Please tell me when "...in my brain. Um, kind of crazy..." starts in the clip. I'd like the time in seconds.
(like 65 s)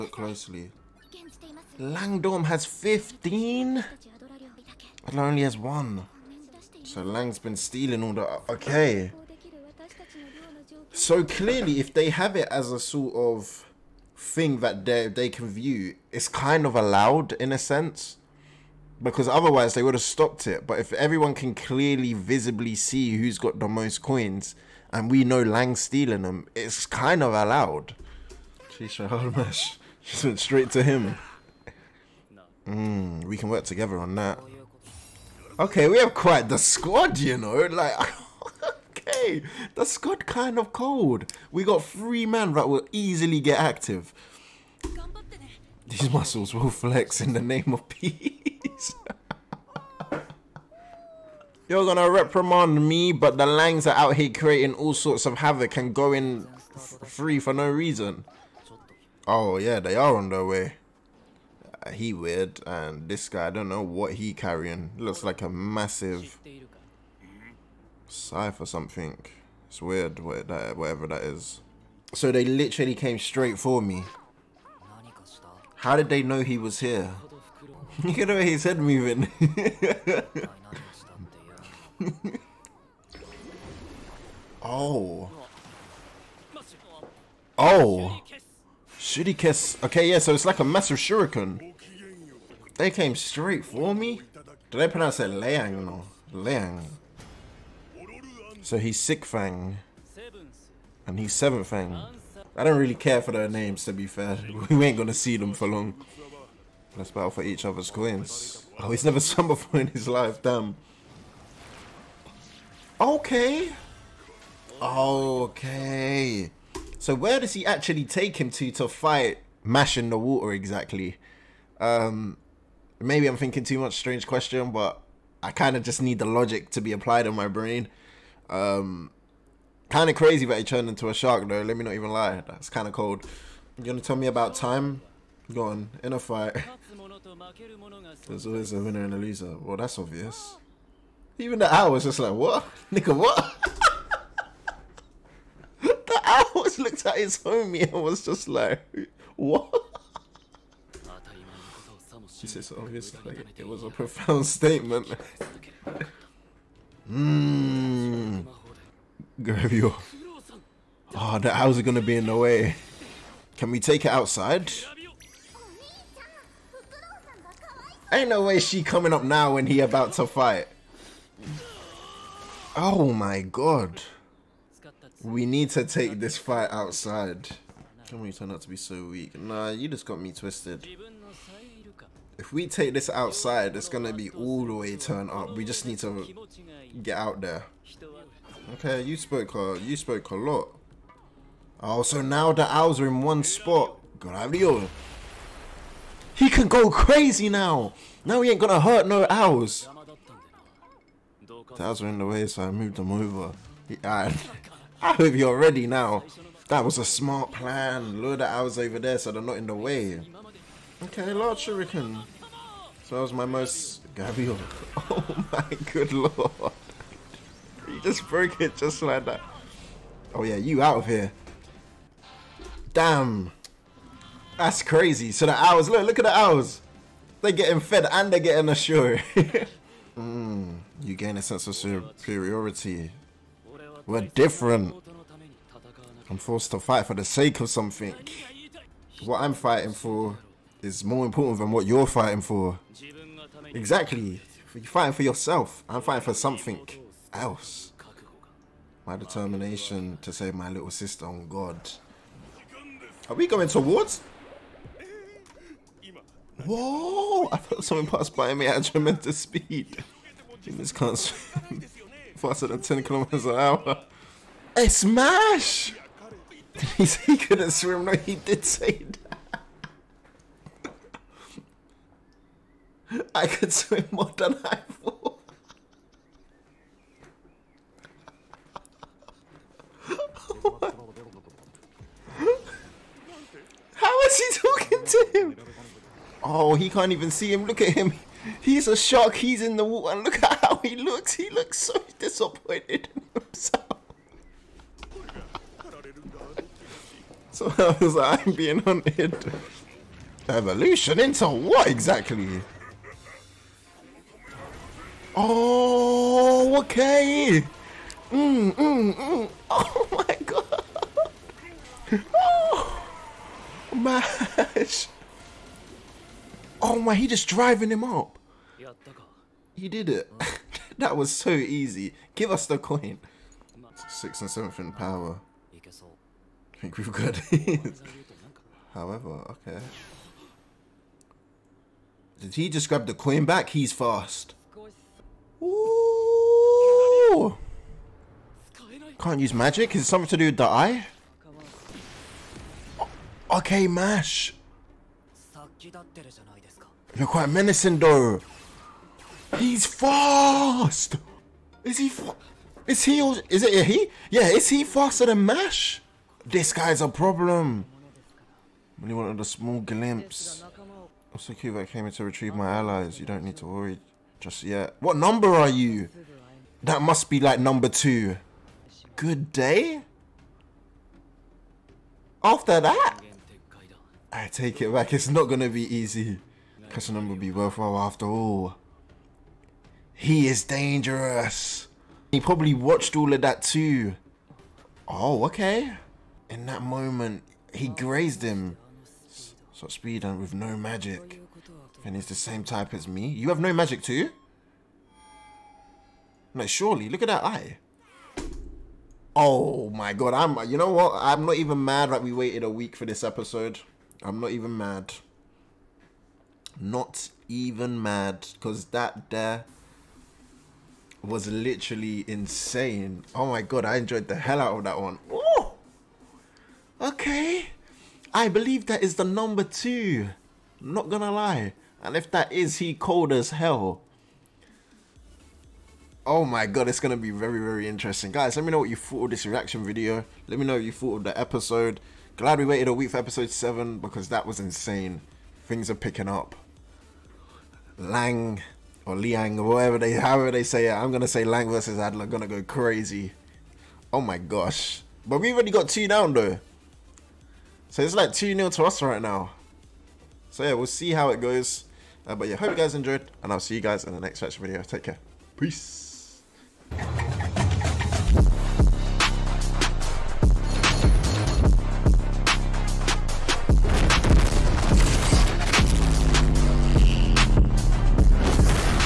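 127 s.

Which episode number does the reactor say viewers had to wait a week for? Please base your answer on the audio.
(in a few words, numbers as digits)
7.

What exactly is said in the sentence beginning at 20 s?
But if everyone can clearly, visibly see who's got the most coins, and we know Lang's stealing them, it's kind of allowed.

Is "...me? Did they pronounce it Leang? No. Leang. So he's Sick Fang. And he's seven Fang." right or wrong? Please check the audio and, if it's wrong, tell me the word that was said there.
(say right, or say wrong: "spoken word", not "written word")
right.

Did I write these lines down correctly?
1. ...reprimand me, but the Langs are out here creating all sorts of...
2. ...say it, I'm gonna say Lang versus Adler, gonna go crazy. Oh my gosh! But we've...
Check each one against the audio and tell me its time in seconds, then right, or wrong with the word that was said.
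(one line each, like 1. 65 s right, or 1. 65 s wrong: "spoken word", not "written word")
1. 52 s right
2. 440 s right.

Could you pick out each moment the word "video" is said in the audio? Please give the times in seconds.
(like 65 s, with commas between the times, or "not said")
429 s, 454 s.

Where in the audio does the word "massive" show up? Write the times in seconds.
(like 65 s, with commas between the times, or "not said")
65 s, 90 s.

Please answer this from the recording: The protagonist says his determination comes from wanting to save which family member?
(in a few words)
little sister.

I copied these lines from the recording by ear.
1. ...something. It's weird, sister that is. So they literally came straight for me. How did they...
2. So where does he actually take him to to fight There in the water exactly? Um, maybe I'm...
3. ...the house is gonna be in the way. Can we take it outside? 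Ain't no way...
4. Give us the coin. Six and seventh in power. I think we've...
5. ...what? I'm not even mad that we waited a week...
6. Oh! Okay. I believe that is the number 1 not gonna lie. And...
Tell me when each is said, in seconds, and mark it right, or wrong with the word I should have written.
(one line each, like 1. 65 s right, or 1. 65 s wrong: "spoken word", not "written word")
1. 68 s wrong: "whatever", not "sister"
2. 116 s wrong: "Mash", not "There"
3. 161 s right
4. 322 s right
5. 400 s right
6. 415 s wrong: "2", not "1".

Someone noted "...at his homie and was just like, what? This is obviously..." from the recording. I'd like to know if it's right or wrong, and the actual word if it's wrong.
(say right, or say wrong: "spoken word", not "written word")
right.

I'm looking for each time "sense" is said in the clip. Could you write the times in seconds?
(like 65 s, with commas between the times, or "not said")
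17 s, 231 s.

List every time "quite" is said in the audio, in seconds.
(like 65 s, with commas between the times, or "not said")
36 s, 347 s.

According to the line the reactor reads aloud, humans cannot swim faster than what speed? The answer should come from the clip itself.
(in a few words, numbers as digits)
10 kilometers an hour.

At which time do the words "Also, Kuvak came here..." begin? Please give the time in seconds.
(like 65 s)
361 s.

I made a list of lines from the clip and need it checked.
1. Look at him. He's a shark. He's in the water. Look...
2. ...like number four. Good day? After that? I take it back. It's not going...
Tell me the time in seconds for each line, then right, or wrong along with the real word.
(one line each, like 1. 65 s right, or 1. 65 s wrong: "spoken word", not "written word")
1. 287 s right
2. 367 s wrong: "two", not "four".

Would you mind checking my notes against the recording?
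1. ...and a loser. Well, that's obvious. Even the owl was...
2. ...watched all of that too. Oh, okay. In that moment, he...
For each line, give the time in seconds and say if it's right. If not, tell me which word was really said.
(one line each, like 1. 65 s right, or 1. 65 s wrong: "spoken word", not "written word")
1. 139 s right
2. 382 s right.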